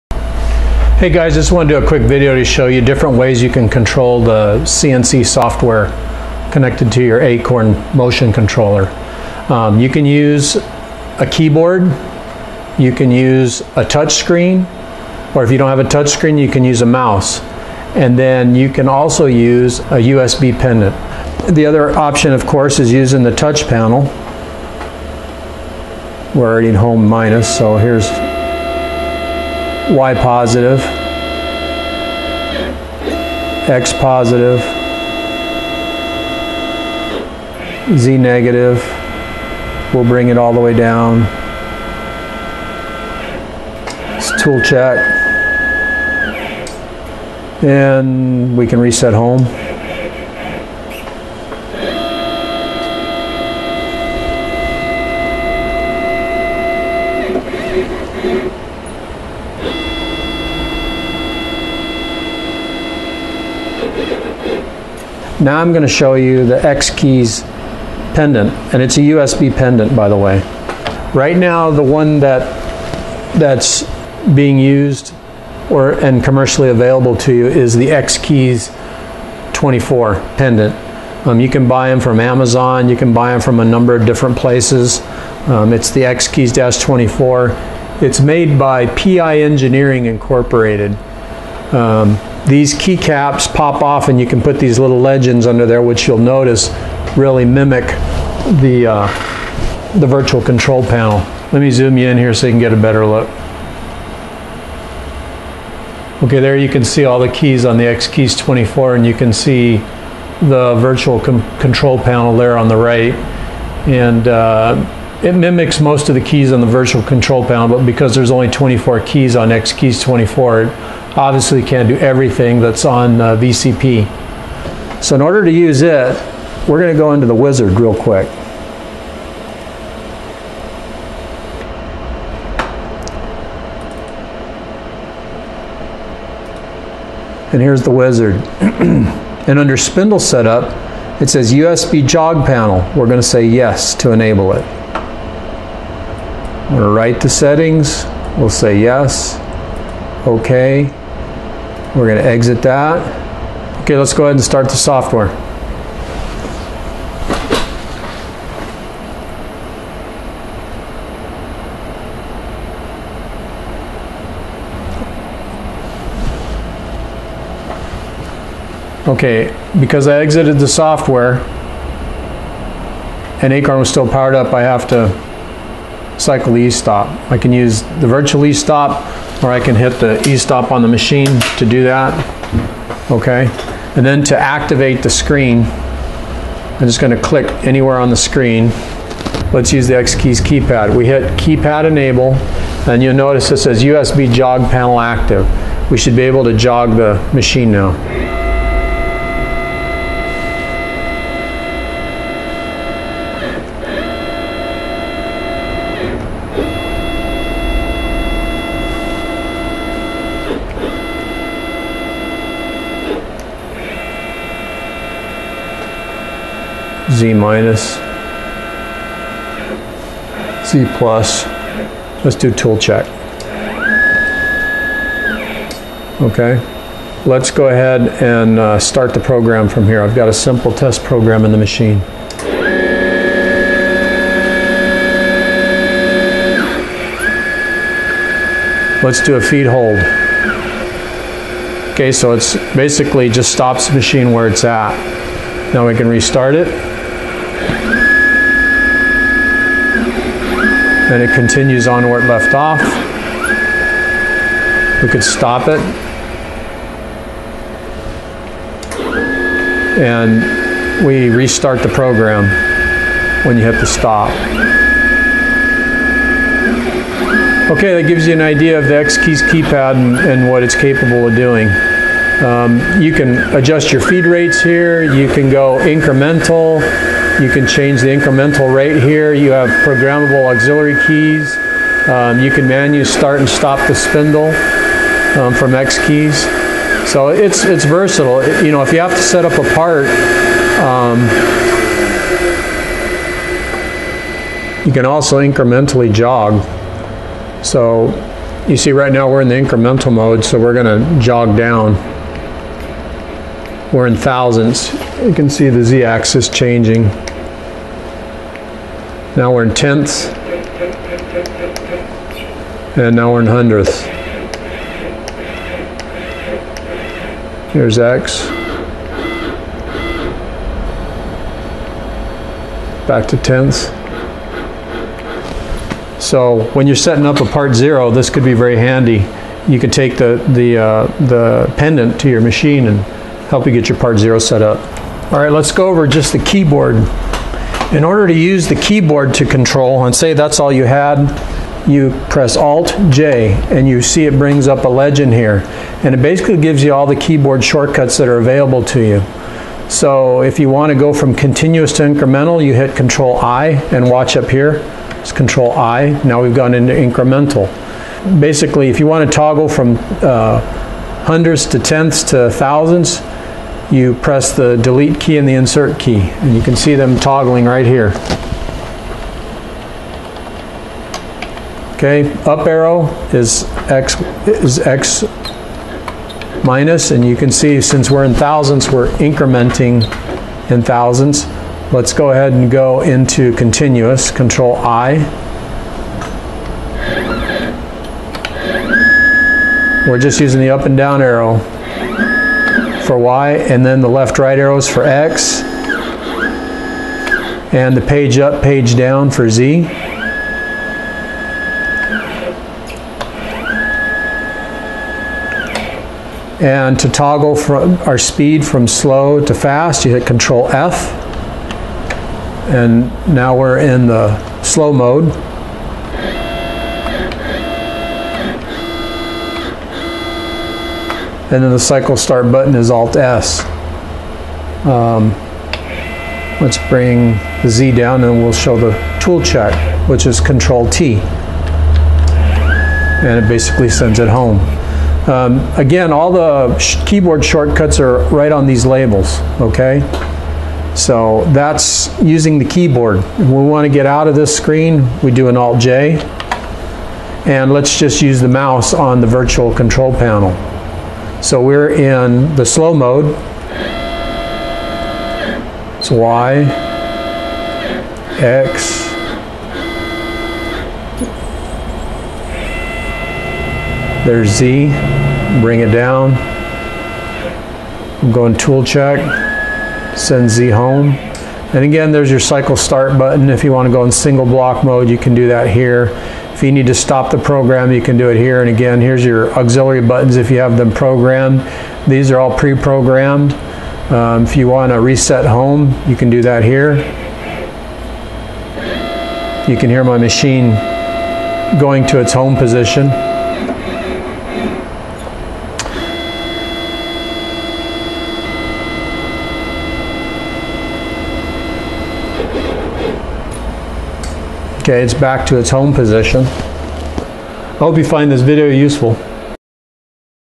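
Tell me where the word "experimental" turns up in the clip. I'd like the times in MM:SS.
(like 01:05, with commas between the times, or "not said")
not said.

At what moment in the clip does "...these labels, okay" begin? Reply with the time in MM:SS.
07:18.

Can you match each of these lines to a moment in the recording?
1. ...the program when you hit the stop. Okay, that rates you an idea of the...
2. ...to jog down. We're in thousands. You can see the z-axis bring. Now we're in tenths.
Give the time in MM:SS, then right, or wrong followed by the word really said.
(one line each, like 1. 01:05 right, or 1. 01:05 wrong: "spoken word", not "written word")
1. 04:21 wrong: "gives", not "rates"
2. 05:01 wrong: "changing", not "bring".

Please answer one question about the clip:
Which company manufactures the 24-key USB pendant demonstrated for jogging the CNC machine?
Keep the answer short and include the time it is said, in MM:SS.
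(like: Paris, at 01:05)
PI Engineering Incorporated, at 01:28.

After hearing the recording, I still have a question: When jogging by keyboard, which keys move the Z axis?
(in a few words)
Page up, page down.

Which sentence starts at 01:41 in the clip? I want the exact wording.
Let me zoom you in here so you can get a better look.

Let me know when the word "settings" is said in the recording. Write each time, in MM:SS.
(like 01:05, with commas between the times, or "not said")
02:27, 05:26.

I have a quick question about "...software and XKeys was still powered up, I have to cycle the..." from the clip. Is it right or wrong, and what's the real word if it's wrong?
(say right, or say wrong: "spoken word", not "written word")
wrong: "Acorn", not "XKeys".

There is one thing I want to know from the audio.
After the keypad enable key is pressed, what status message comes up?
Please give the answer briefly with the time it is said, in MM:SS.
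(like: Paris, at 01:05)
USB jog panel active, at 03:13.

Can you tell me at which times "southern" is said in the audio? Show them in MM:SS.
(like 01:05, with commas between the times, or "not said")
not said.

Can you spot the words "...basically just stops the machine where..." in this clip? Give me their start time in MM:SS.
04:02.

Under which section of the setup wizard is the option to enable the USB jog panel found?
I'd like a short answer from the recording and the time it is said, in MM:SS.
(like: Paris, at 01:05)
Spindle setup, at 02:19.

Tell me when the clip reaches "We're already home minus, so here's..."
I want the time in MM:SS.
00:26.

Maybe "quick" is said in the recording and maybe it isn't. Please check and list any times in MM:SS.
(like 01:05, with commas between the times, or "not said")
00:01, 02:07.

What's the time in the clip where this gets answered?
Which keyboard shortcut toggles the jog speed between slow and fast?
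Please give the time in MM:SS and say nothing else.
06:50.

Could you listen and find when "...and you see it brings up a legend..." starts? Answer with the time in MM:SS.
05:43.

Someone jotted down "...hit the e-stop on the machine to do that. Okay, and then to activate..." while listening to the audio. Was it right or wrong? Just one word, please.
right.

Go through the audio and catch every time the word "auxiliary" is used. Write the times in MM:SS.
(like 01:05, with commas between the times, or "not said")
04:40, 07:59.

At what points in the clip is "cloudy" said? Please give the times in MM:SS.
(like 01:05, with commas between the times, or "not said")
not said.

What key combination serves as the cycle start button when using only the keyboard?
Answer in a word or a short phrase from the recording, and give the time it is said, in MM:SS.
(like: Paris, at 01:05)
Alt S, at 07:02.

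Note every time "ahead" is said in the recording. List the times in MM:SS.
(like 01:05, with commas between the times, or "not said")
02:34, 03:47, 06:22.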